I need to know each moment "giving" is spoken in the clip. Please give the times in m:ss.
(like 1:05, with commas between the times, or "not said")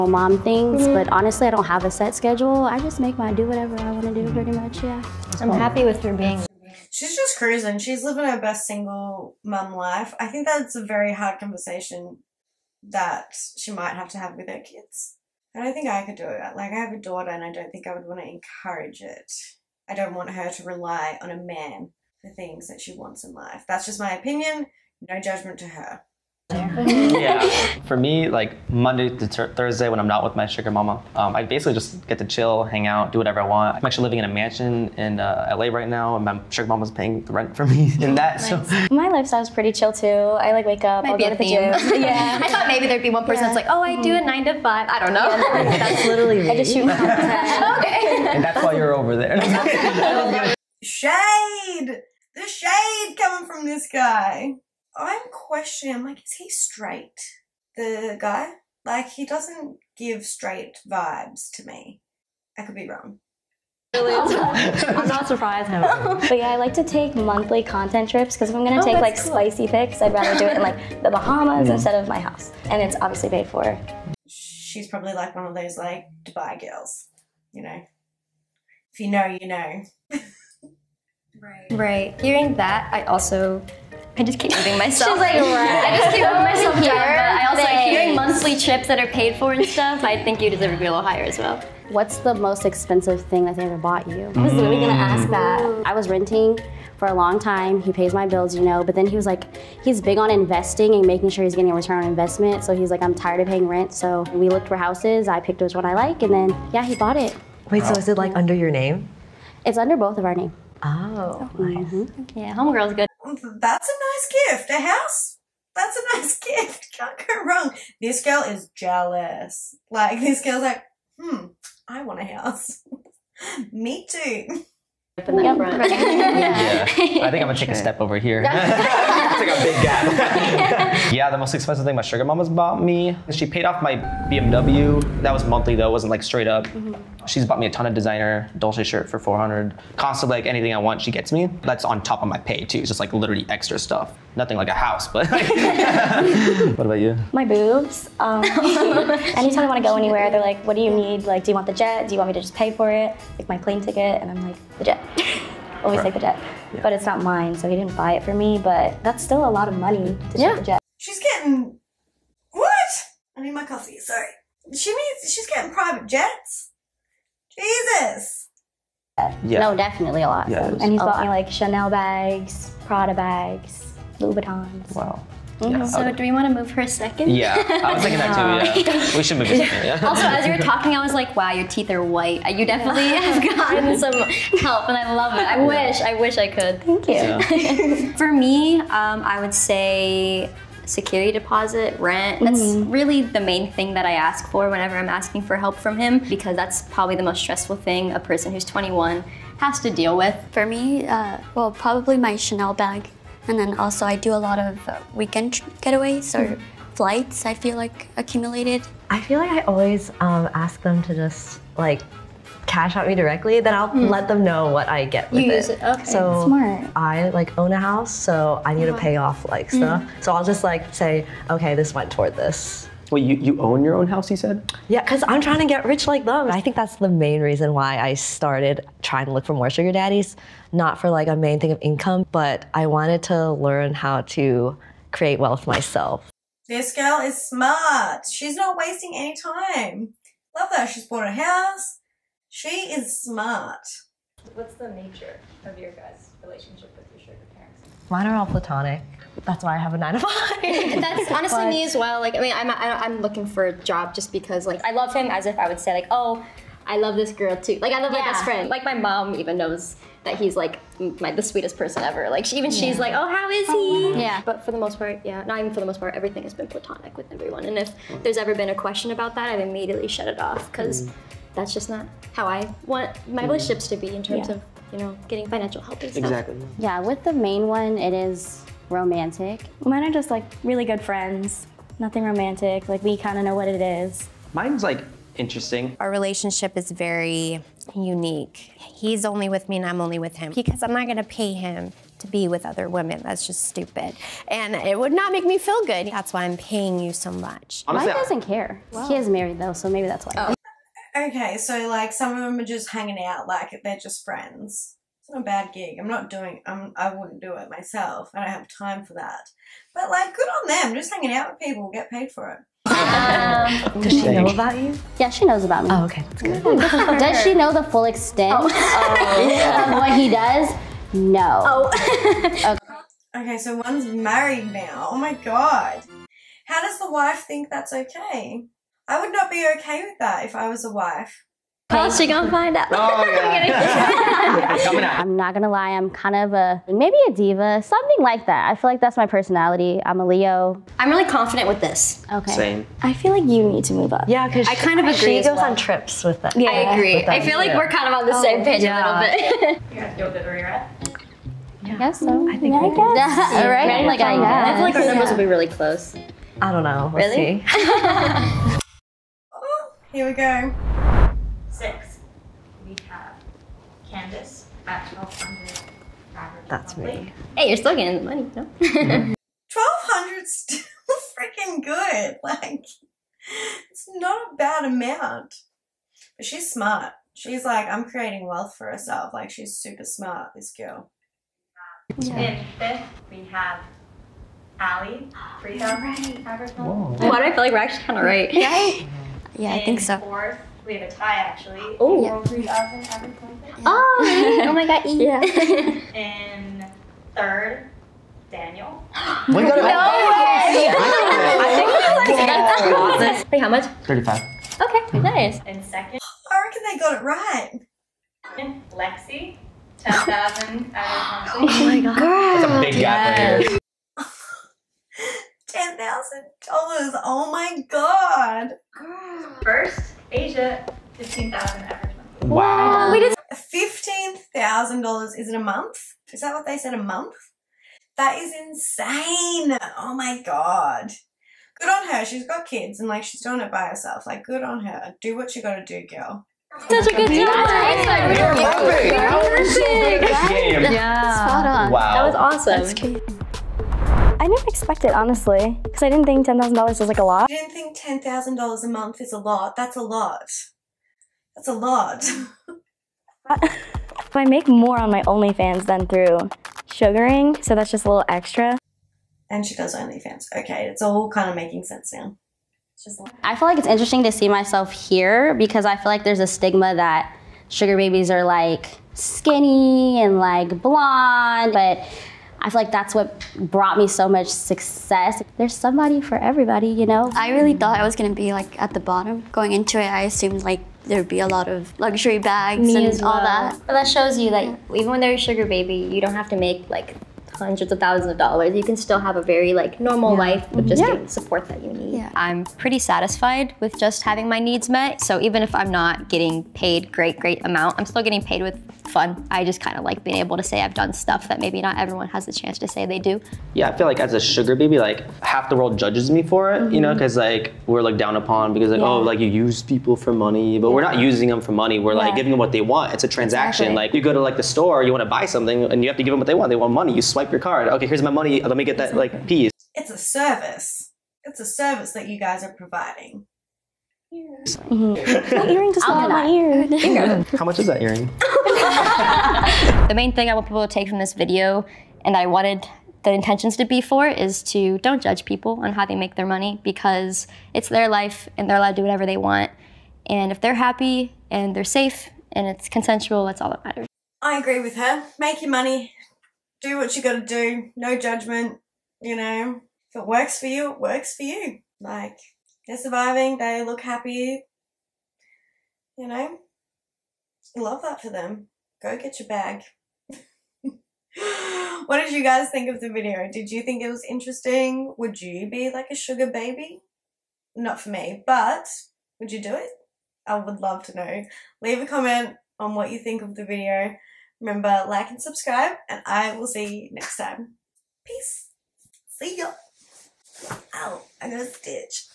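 8:32.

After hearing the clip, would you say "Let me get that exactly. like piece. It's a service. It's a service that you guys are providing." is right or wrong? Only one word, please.
right.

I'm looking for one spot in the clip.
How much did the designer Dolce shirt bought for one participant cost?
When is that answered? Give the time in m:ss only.
2:19.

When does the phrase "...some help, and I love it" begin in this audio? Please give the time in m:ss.
3:03.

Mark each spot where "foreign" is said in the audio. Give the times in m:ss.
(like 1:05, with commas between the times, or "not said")
not said.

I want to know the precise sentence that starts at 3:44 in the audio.
Yeah, because I'm trying to get rich like them.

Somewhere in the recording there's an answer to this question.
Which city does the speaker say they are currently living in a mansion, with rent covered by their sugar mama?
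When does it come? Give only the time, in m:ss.
0:35.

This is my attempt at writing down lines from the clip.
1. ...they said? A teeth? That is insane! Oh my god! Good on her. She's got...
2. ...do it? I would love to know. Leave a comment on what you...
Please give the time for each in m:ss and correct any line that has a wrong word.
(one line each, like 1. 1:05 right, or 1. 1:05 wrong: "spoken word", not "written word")
1. 7:06 wrong: "month", not "teeth"
2. 9:29 right.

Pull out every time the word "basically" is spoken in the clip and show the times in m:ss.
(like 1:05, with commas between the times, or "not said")
0:31.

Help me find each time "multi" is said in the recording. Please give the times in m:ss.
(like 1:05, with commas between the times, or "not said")
not said.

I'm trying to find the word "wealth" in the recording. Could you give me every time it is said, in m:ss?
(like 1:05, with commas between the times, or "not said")
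3:55, 6:18.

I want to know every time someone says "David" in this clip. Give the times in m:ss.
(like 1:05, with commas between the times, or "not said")
not said.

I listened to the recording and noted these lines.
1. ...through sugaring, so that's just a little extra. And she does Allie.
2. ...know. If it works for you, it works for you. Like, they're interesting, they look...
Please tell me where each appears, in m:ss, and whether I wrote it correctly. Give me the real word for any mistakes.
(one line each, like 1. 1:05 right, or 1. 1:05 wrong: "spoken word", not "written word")
1. 7:36 wrong: "OnlyFans", not "Allie"
2. 9:09 wrong: "surviving", not "interesting".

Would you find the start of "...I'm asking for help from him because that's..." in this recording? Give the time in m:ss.
3:14.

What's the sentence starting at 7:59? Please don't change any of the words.
Going into it, I assumed like there'd be a lot of luxury bags me and all well.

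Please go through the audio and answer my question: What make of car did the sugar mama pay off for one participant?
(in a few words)
BMW.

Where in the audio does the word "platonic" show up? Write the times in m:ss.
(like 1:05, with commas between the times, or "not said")
4:08, 4:26.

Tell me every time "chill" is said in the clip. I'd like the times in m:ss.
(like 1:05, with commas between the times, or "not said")
0:32, 0:39.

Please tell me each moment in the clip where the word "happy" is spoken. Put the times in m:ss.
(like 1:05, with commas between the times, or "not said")
0:05, 9:00, 9:13.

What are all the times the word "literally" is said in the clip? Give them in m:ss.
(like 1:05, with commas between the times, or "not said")
0:46, 1:34, 2:23.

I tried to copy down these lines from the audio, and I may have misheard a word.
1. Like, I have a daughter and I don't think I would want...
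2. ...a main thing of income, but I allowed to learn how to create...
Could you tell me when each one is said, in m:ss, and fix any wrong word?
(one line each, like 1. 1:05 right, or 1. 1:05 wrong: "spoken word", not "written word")
1. 0:16 right
2. 3:51 wrong: "wanted", not "allowed".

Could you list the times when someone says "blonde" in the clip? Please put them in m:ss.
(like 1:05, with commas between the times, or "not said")
7:50.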